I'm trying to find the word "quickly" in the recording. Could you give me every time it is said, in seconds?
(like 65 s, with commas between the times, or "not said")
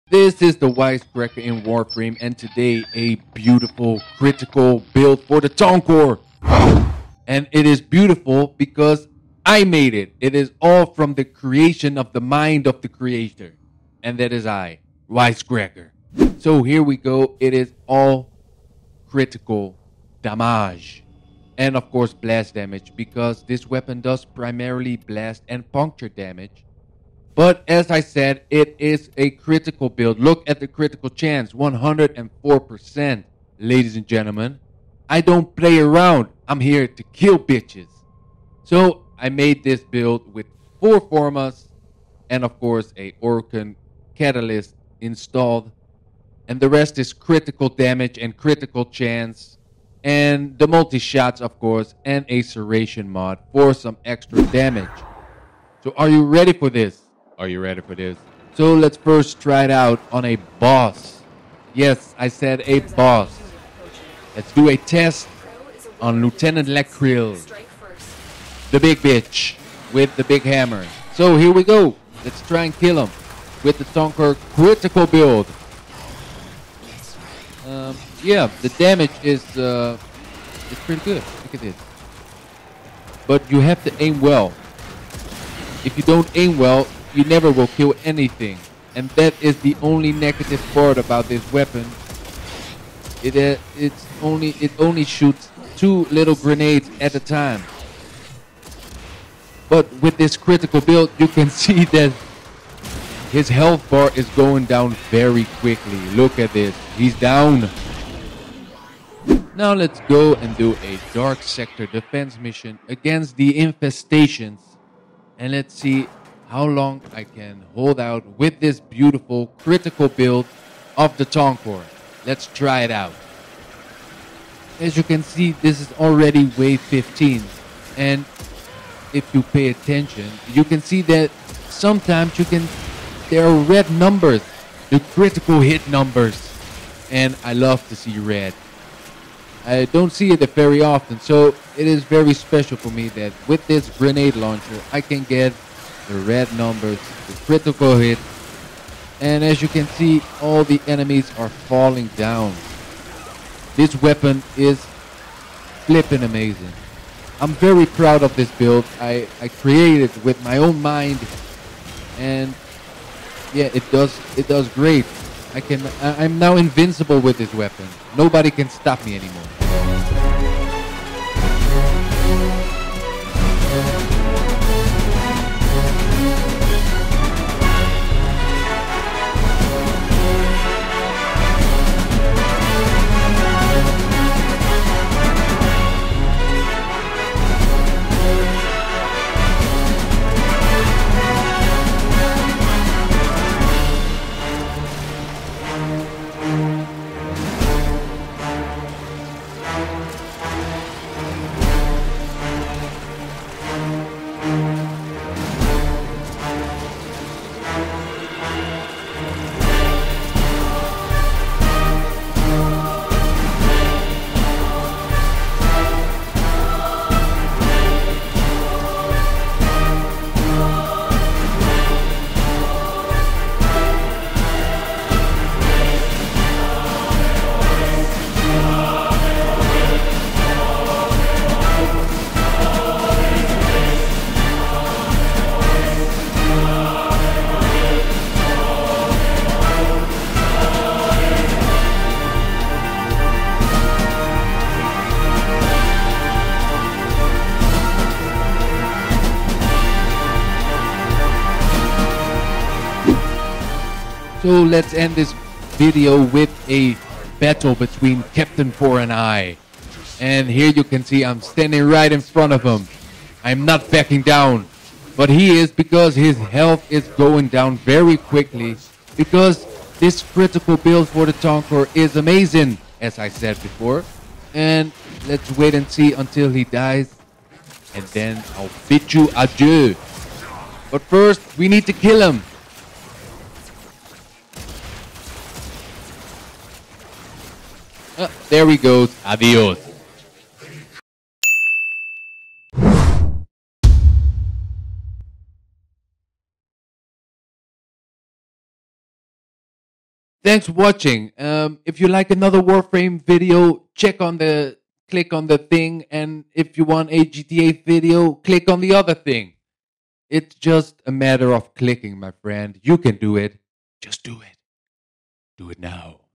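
105 s, 268 s.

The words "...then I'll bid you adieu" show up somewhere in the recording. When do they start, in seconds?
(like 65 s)
278 s.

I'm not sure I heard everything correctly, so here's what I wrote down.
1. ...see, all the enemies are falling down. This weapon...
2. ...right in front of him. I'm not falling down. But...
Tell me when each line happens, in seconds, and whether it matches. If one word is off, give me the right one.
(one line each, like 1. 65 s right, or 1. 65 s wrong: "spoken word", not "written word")
1. 149 s right
2. 261 s wrong: "backing", not "falling".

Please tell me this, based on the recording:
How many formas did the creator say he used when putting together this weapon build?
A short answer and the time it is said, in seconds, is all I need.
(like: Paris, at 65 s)
4, at 40 s.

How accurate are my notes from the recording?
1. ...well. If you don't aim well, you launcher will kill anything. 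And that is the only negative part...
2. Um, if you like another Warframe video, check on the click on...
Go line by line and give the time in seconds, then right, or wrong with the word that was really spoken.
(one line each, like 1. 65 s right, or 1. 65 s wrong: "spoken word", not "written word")
1. 84 s wrong: "never", not "launcher"
2. 301 s right.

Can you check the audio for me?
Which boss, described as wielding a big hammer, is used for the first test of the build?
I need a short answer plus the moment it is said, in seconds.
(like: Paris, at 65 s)
Lieutenant Lech Kril, at 66 s.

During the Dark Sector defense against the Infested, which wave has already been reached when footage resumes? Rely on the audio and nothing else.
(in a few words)
15.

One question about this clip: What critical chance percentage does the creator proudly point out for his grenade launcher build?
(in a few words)
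104%.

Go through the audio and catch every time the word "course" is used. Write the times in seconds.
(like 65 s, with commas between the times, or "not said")
21 s, 42 s, 51 s.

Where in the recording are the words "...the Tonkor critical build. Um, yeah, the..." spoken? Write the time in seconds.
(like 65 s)
73 s.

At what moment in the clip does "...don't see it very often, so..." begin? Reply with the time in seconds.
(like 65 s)
139 s.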